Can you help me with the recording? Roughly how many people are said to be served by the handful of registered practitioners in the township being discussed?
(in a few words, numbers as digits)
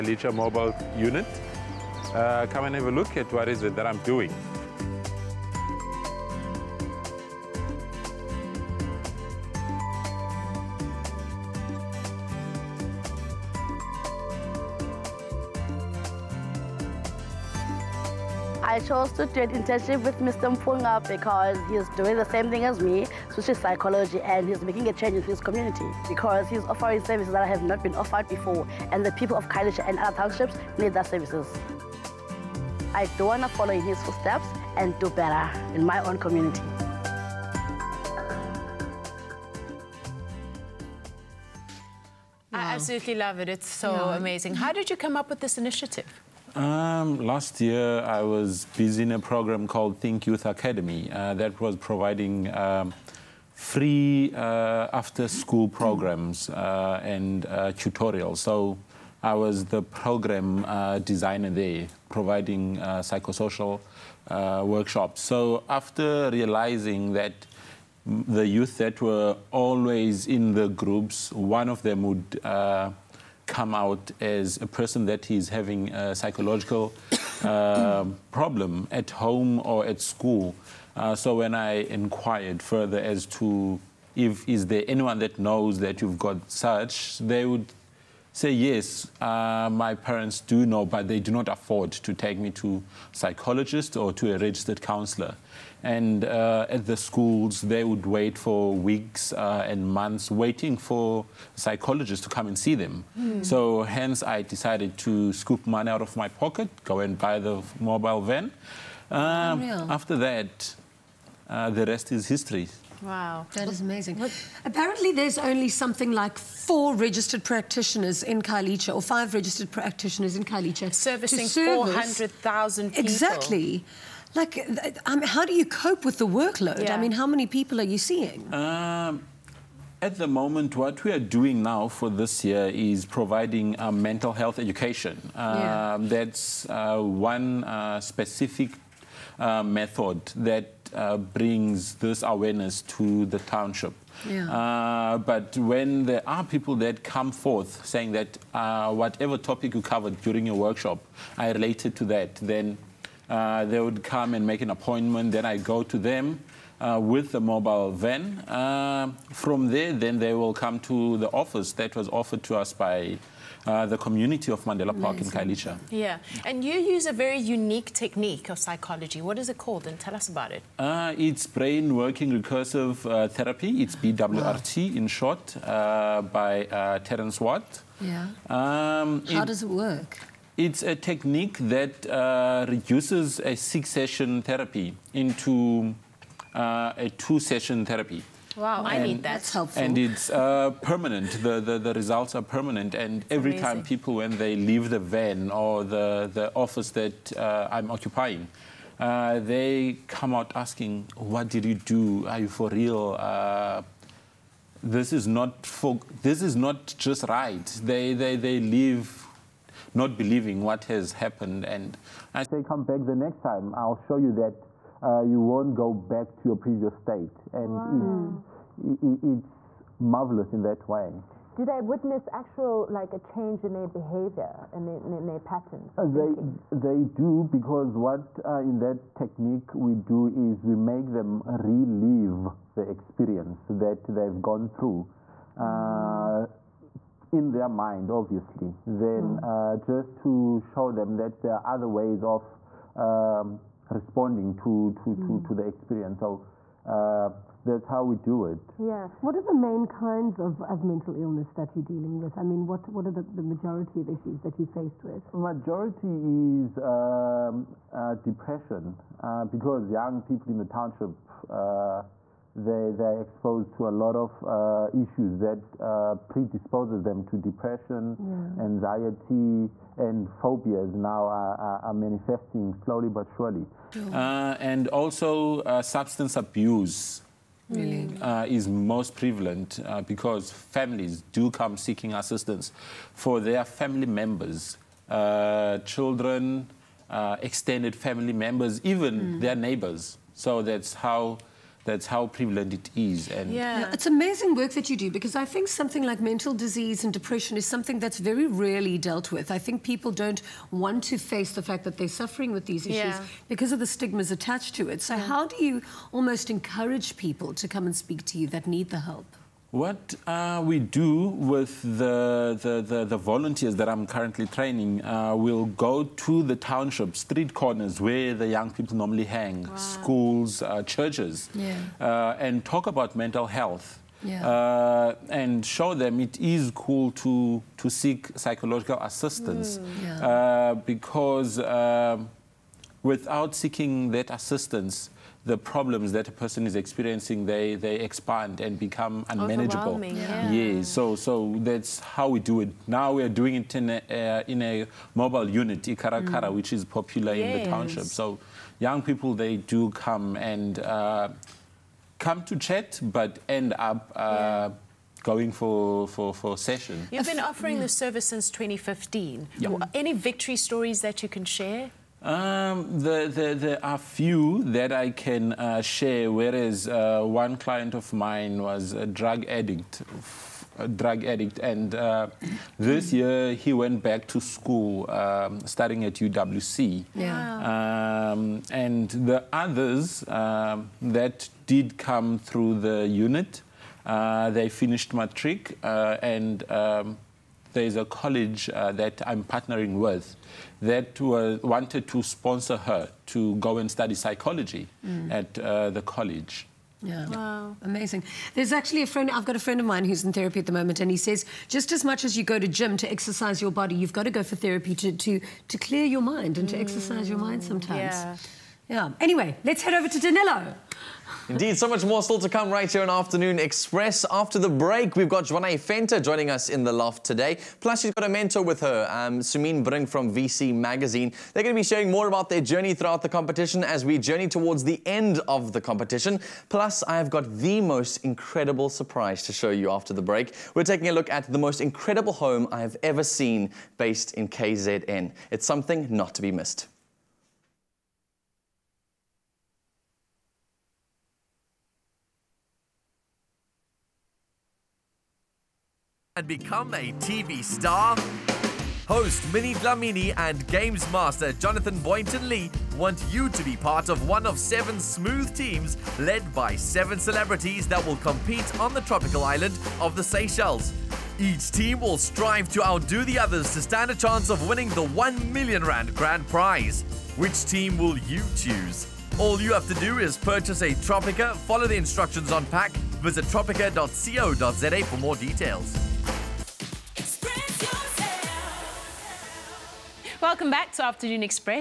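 400,000.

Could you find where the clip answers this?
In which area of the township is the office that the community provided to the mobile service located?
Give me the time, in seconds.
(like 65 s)
164 s.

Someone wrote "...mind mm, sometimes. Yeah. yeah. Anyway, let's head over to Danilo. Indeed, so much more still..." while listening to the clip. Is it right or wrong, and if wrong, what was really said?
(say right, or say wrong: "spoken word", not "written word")
right.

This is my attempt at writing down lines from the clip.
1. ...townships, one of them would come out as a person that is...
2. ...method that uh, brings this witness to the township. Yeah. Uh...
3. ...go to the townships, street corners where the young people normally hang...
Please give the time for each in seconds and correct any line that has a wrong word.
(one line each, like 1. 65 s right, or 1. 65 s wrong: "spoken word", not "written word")
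1. 70 s wrong: "groups", not "townships"
2. 139 s wrong: "awareness", not "witness"
3. 315 s right.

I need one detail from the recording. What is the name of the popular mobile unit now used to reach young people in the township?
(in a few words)
Ikarakara.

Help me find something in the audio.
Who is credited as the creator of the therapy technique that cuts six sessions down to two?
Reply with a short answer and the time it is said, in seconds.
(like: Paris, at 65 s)
Terence Watt, at 176 s.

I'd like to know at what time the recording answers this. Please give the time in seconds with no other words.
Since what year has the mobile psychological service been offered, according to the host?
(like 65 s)
358 s.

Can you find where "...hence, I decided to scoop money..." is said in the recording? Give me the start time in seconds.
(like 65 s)
103 s.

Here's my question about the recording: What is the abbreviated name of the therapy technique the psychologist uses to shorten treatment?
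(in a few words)
BWRT.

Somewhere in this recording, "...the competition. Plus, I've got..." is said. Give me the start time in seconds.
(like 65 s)
425 s.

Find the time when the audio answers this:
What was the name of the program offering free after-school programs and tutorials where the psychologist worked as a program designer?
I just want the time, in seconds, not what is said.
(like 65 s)
49 s.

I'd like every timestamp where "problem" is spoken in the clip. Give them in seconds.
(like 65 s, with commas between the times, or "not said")
78 s, 335 s.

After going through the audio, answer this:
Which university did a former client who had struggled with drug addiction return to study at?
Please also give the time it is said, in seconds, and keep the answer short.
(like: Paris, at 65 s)
UWC, at 376 s.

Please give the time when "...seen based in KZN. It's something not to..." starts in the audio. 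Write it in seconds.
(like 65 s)
433 s.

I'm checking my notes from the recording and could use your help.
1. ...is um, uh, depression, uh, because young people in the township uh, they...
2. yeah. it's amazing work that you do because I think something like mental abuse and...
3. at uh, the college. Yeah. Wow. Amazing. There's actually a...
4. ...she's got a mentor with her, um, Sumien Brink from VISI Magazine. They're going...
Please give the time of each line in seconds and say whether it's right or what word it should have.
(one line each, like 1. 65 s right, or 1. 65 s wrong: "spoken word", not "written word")
1. 256 s right
2. 293 s wrong: "disease", not "abuse"
3. 395 s right
4. 418 s right.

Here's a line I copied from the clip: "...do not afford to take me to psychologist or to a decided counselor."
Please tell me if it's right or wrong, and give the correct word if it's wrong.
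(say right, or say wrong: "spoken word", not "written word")
wrong: "registered", not "decided".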